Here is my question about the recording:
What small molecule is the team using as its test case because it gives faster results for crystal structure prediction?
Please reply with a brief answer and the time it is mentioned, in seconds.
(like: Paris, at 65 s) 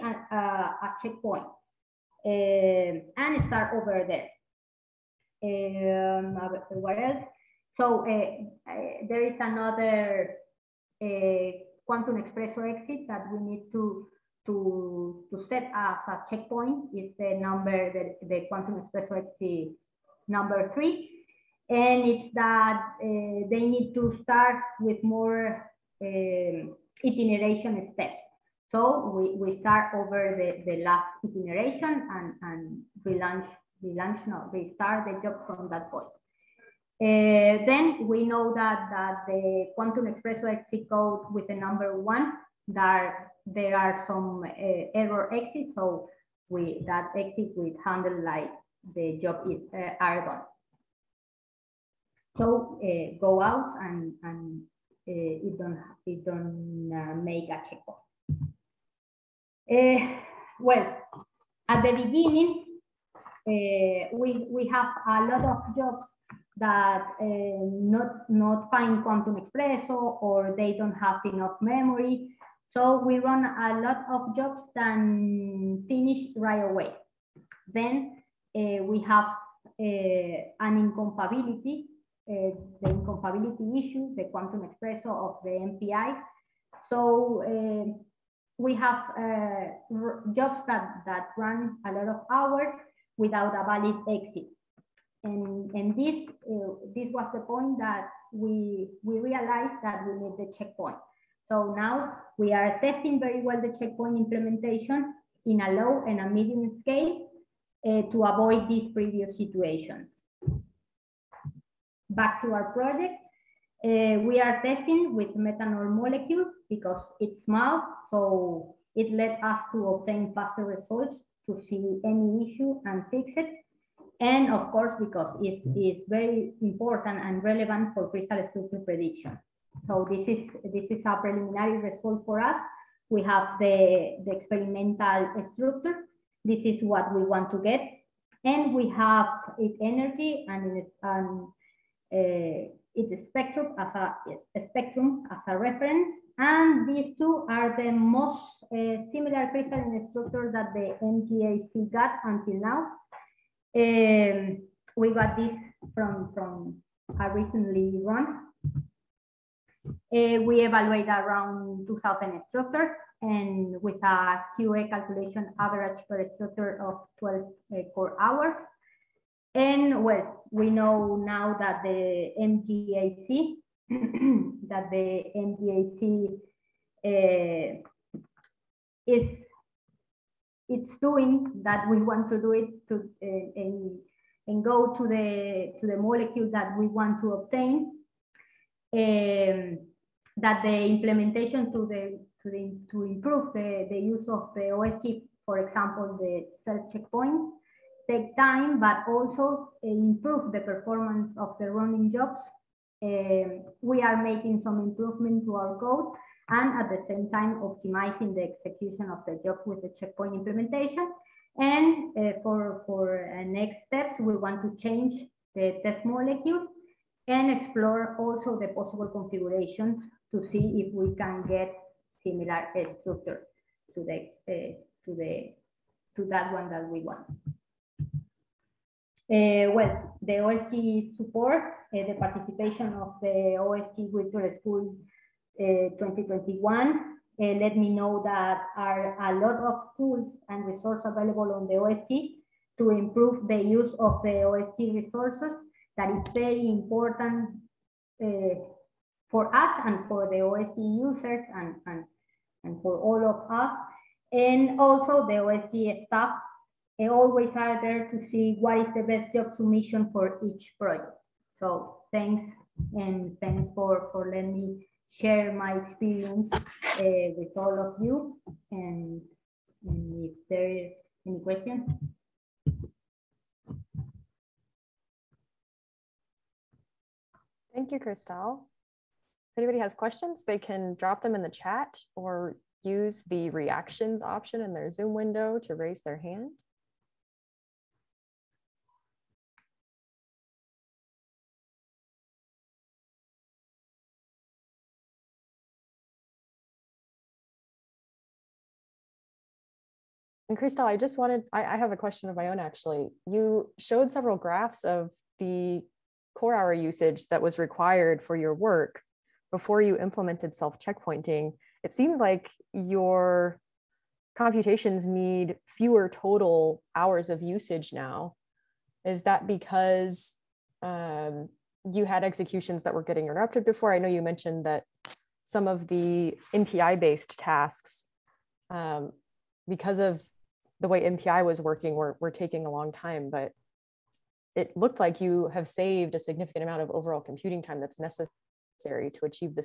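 Methanol, at 115 s.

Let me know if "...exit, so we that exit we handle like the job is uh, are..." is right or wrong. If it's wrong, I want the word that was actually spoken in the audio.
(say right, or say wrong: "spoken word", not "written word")
right.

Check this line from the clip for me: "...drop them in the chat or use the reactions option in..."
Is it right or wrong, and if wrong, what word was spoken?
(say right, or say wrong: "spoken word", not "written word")
right.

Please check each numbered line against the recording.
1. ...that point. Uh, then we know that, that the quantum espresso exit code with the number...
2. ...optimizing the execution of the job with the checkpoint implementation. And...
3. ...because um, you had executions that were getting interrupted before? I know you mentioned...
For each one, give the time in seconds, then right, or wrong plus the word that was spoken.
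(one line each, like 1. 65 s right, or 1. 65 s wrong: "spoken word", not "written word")
1. 35 s right
2. 207 s right
3. 319 s right.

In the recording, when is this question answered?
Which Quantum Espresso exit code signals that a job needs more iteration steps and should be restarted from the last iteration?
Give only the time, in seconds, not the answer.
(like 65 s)
20 s.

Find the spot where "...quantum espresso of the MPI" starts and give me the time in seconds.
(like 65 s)
84 s.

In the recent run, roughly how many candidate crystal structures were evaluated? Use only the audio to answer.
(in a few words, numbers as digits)
2,000.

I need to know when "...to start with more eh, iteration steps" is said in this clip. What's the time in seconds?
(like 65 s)
23 s.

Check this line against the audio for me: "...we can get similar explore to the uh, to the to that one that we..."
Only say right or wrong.
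wrong.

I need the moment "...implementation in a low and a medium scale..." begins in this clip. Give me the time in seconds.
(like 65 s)
104 s.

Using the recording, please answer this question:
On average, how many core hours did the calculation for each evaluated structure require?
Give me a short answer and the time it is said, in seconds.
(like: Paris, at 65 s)
12, at 167 s.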